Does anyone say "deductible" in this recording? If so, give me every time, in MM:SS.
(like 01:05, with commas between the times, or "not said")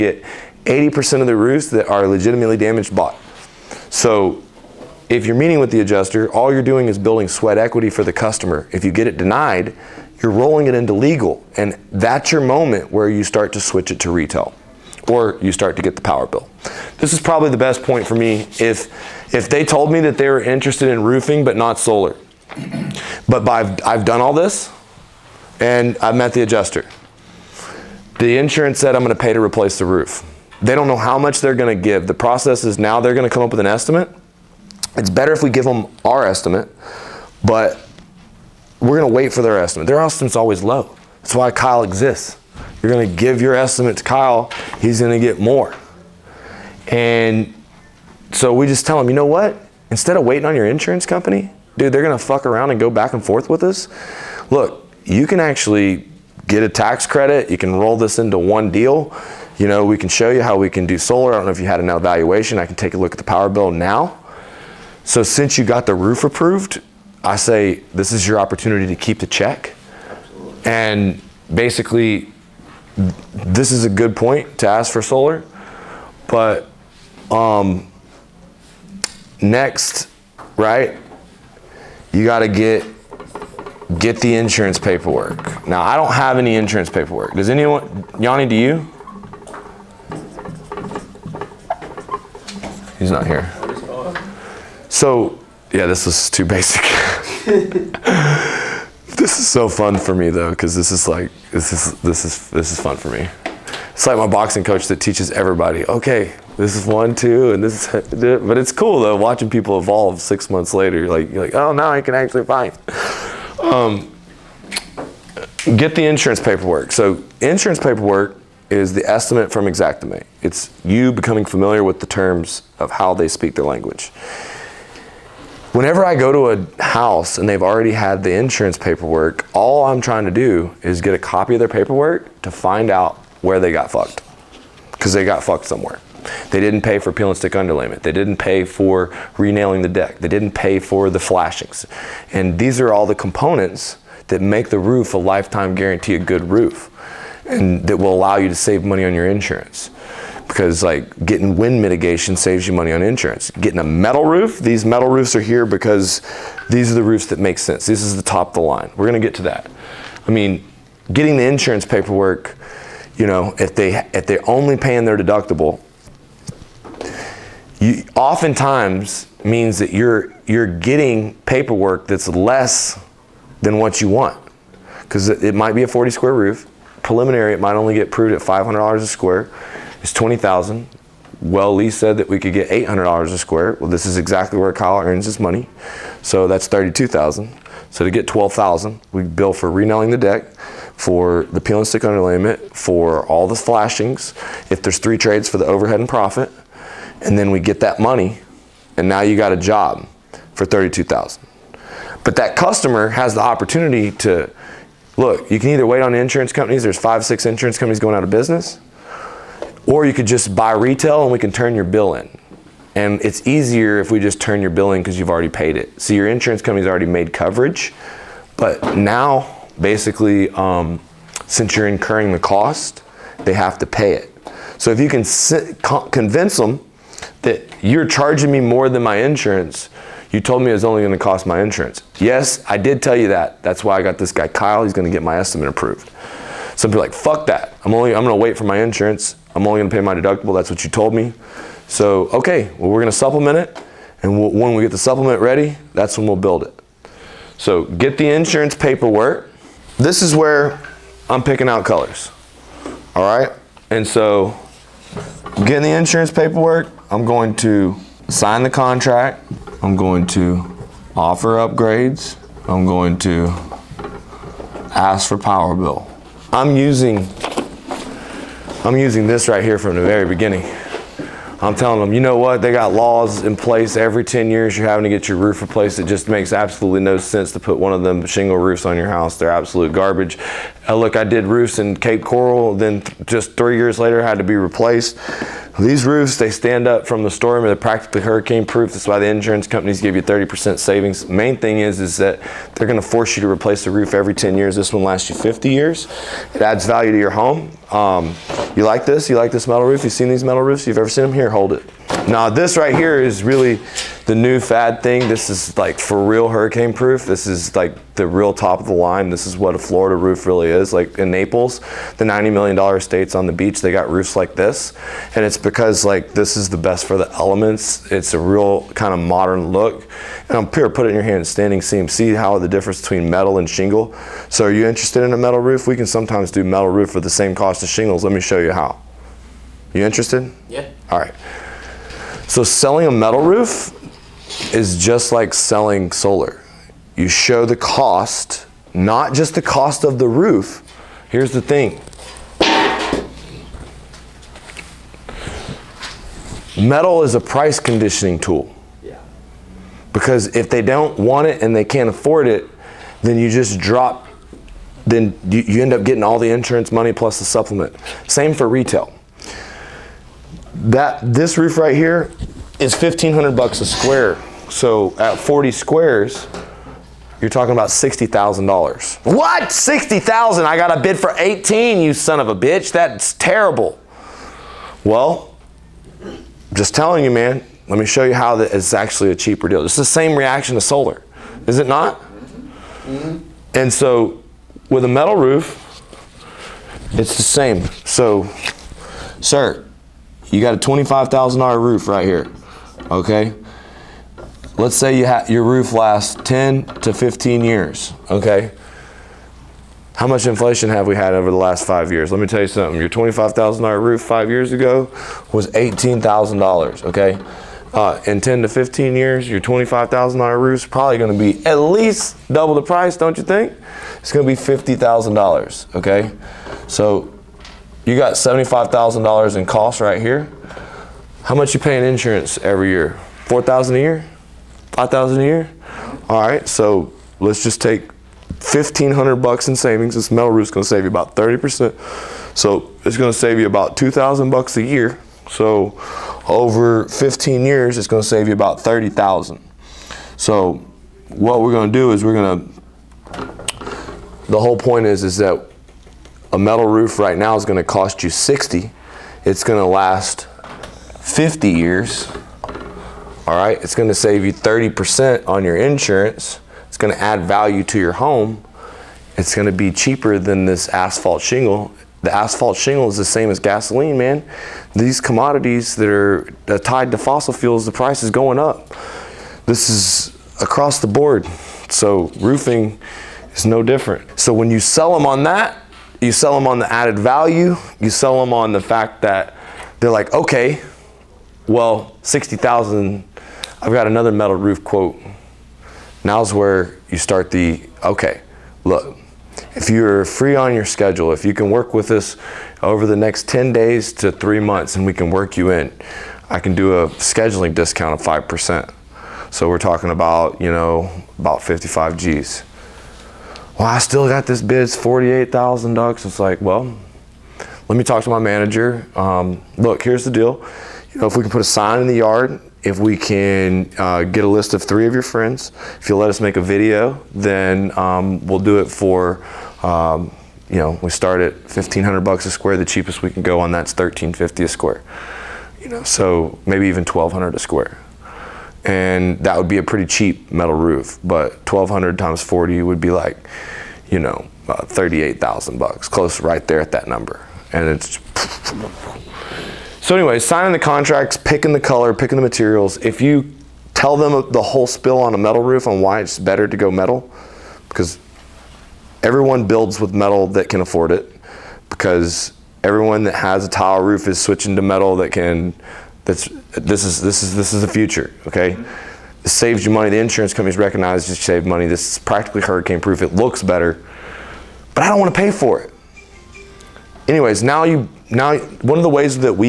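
02:45, 04:00.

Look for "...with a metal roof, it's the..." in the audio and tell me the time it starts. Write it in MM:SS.
06:24.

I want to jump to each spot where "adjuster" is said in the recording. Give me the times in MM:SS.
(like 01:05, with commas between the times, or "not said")
00:05, 00:26.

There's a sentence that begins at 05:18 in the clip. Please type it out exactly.
It's a real kind of modern look.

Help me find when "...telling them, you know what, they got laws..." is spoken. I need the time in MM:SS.
04:31.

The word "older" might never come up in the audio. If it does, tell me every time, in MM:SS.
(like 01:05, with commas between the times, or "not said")
not said.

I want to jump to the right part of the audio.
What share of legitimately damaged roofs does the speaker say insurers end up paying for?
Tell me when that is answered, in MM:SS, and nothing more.
00:00.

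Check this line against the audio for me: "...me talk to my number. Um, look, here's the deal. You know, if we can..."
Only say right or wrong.
wrong.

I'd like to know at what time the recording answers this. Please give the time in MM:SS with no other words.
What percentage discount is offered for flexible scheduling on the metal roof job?
08:18.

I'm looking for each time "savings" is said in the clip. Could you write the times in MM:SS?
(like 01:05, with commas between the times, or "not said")
04:50, 07:09.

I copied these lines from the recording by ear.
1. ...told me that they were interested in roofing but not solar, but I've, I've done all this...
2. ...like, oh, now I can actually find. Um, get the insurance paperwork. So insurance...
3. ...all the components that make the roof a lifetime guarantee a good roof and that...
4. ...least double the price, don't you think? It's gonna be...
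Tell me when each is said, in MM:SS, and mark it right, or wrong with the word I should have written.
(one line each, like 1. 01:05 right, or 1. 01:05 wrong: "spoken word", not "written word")
1. 00:19 right
2. 01:51 right
3. 02:22 right
4. 06:51 right.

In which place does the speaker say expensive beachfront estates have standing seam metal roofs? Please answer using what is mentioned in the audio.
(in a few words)
Naples.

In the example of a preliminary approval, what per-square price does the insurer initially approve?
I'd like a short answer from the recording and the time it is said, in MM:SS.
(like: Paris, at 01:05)
$500, at 02:58.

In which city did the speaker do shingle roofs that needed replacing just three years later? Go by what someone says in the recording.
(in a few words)
Cape Coral.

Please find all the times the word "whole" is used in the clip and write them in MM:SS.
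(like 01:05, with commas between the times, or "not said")
07:24, 09:04.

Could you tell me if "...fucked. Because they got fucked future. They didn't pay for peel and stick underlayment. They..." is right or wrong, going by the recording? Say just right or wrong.
wrong.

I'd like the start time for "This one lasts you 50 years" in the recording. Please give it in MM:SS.
04:54.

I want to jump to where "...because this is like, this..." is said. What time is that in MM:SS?
01:40.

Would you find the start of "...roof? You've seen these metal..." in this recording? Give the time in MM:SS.
04:59.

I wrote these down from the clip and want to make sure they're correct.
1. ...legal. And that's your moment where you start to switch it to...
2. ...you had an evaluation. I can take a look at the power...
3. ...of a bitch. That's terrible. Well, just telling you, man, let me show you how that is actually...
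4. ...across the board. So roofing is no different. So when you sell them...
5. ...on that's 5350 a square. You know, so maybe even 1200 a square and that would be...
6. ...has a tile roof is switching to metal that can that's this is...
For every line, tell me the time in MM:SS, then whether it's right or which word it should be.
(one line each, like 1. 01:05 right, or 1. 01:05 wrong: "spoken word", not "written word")
1. 00:10 right
2. 01:01 right
3. 06:12 right
4. 07:50 right
5. 08:43 wrong: "1350", not "5350"
6. 09:13 right.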